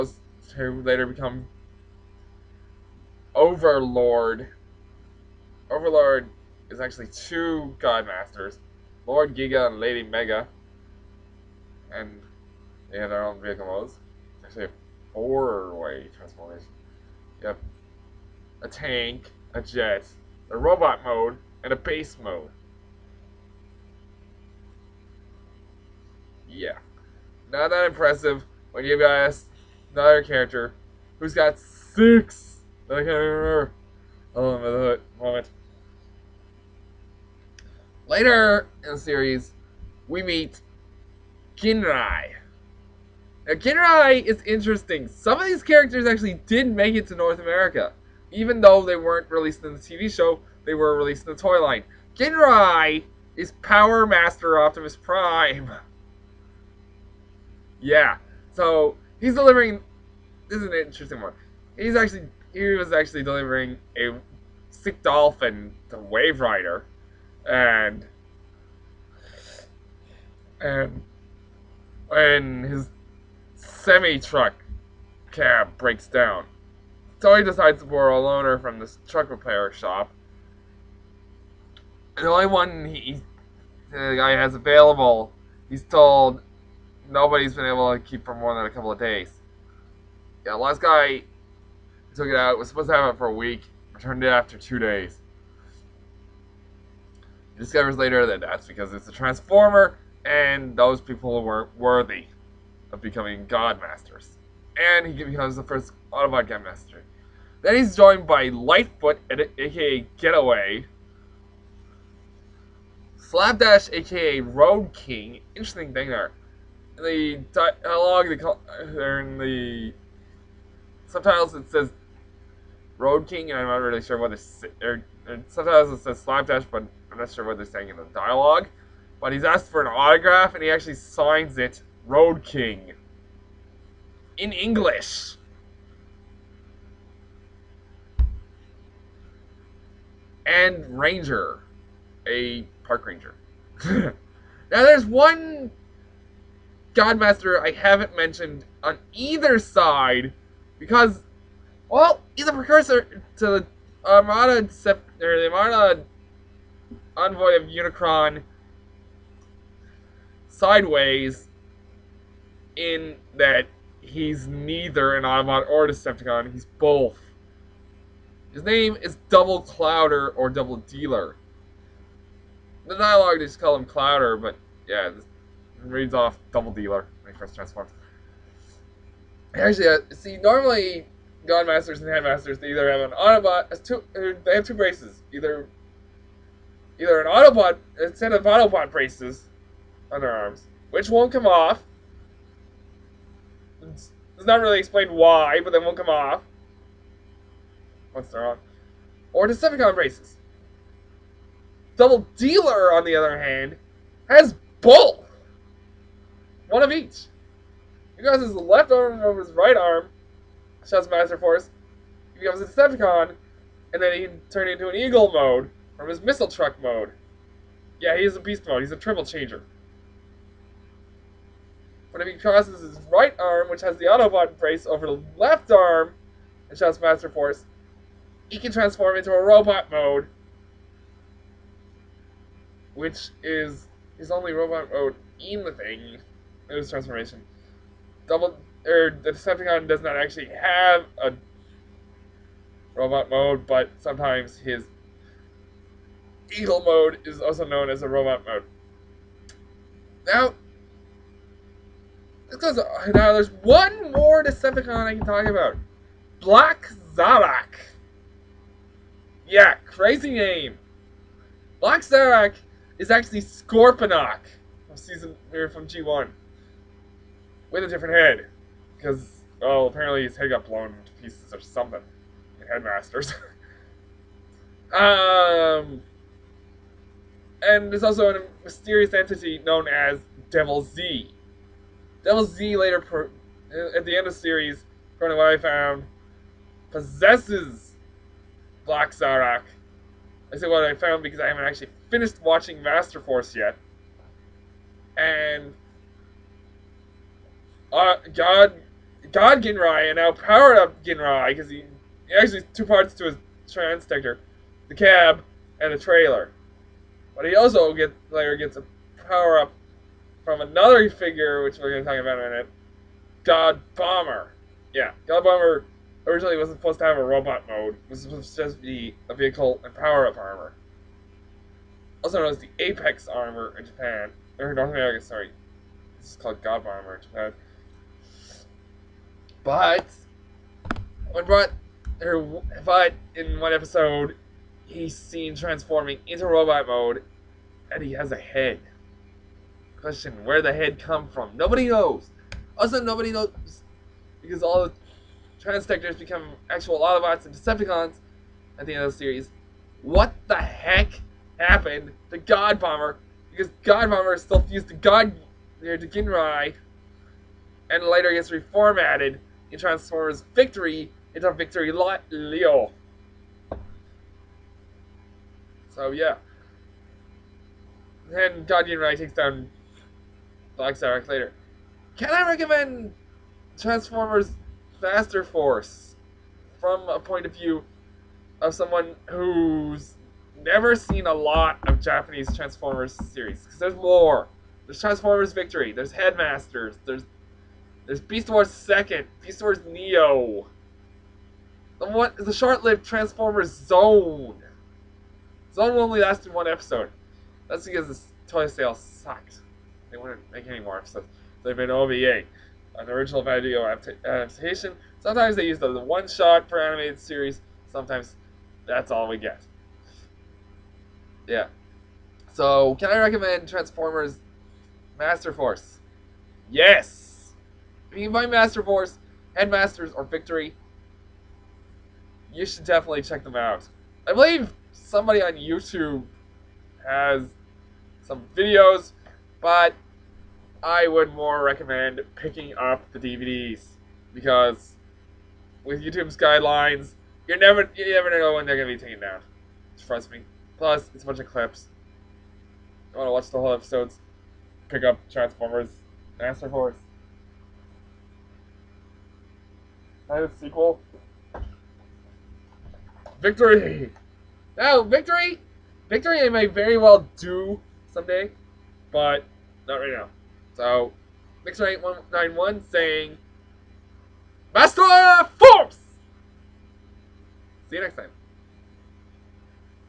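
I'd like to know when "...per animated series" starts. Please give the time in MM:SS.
06:46.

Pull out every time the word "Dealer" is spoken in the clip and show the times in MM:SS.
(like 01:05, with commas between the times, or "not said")
02:50, 02:56, 03:22.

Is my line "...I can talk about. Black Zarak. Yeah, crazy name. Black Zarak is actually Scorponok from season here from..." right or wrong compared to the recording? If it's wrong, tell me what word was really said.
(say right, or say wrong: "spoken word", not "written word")
right.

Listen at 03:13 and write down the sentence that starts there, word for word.
It's, it's not really explained why, but they won't come off.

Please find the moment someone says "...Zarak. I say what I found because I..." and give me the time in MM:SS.
04:49.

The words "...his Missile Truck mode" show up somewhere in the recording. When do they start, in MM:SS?
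03:36.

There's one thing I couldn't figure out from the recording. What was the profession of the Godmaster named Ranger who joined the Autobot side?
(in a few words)
Park ranger.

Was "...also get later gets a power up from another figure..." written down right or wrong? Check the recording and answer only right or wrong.
right.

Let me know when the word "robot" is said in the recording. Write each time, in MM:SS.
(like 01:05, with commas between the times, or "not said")
00:20, 03:49, 03:54, 04:02, 04:08, 05:17, 05:36.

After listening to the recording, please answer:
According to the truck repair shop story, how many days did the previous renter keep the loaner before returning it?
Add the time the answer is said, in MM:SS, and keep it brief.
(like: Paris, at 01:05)
2, at 01:34.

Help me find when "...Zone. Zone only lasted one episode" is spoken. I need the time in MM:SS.
06:33.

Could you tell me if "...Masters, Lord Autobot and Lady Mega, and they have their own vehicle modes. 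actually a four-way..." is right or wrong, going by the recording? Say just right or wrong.
wrong.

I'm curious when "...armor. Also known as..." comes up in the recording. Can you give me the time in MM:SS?
05:20.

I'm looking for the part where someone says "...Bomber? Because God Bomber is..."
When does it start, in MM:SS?
05:52.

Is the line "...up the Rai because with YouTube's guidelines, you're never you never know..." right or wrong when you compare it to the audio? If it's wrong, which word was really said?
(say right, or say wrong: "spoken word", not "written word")
wrong: "DVDs", not "Rai".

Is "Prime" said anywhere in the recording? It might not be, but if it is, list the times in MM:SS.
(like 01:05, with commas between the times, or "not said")
00:54.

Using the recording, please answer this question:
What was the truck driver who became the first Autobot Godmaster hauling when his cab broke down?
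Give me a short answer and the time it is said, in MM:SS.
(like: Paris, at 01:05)
A sick dolphin, at 01:03.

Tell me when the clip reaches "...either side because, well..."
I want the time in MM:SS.
02:29.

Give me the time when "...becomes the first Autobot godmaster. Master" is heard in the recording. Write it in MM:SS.
01:45.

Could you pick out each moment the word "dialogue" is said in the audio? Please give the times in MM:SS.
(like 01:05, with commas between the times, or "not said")
01:57, 02:08, 02:52.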